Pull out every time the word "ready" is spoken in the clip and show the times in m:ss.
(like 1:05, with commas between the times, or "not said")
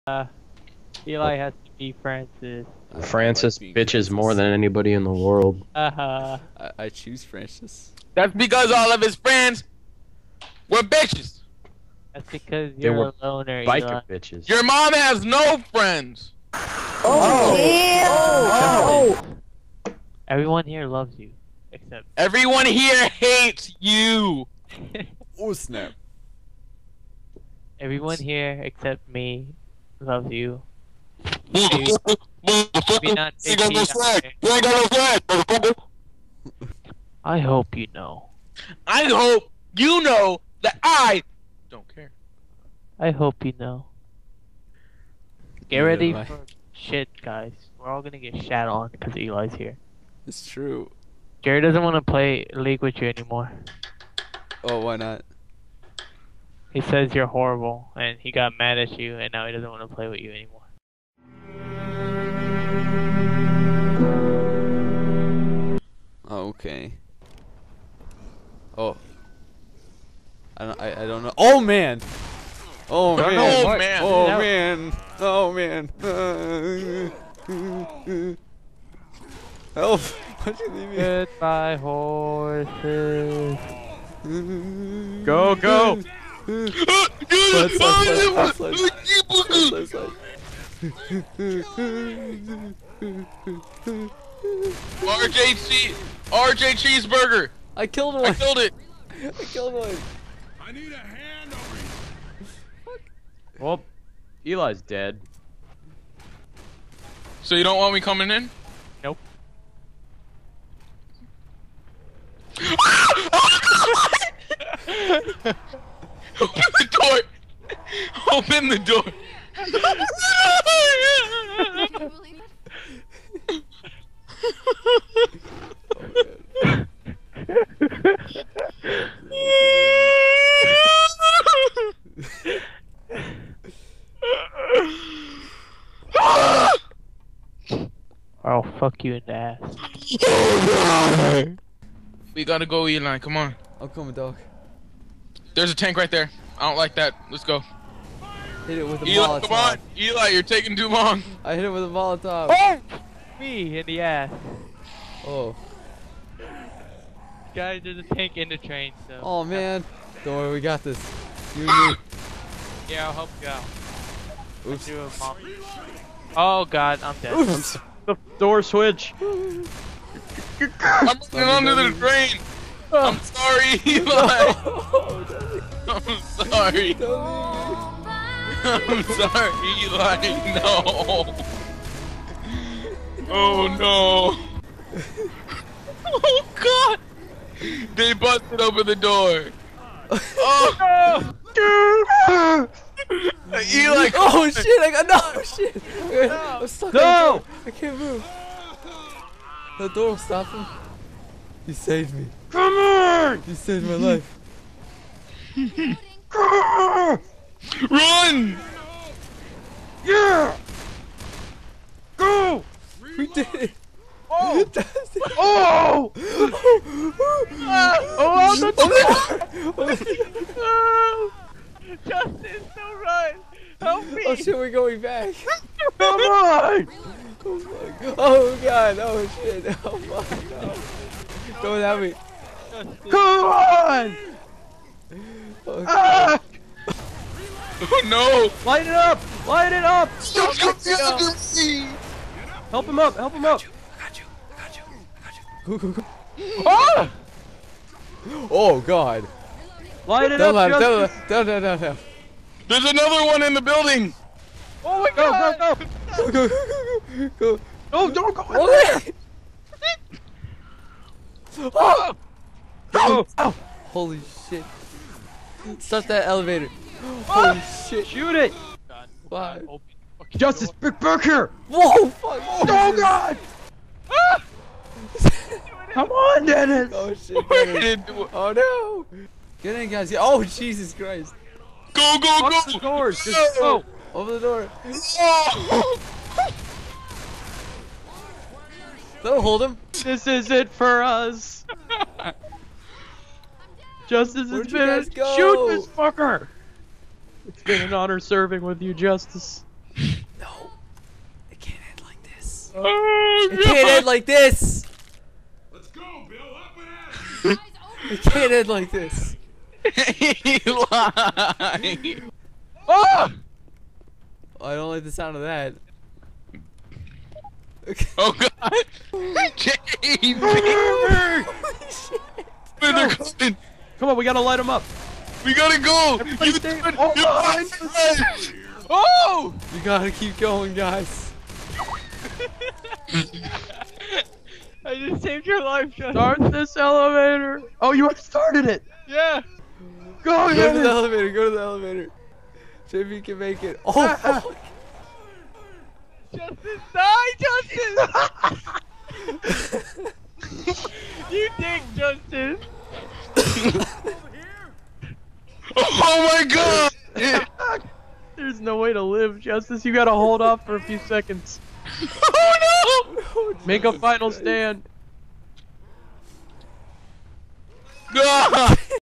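0:45.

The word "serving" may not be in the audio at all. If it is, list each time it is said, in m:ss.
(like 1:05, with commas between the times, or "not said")
4:58.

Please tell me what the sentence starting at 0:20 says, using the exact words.
Everyone here loves you, except everyone here hates you.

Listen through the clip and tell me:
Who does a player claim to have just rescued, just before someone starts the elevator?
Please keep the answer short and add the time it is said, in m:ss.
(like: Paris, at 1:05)
John, at 5:35.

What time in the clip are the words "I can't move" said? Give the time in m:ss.
3:17.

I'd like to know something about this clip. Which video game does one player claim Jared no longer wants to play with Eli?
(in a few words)
League.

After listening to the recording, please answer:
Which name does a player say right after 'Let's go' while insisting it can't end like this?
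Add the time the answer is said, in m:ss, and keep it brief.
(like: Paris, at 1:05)
Bill, at 5:06.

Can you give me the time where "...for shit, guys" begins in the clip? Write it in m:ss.
0:46.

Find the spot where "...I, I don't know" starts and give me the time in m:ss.
1:10.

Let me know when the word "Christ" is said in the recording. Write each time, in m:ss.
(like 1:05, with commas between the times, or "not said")
4:40.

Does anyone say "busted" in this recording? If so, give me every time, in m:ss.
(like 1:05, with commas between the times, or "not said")
3:08.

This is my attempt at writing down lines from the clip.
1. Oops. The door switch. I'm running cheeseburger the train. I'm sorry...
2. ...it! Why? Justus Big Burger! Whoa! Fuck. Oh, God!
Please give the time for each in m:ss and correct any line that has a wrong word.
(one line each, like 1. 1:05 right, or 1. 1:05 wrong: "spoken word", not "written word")
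1. 2:47 wrong: "under", not "cheeseburger"
2. 4:28 right.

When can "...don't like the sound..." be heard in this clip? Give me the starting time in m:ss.
5:14.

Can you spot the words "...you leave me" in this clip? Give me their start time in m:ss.
1:20.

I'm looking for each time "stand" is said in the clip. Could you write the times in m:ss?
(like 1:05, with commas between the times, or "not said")
6:04.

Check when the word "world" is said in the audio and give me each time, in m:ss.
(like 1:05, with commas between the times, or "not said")
0:05.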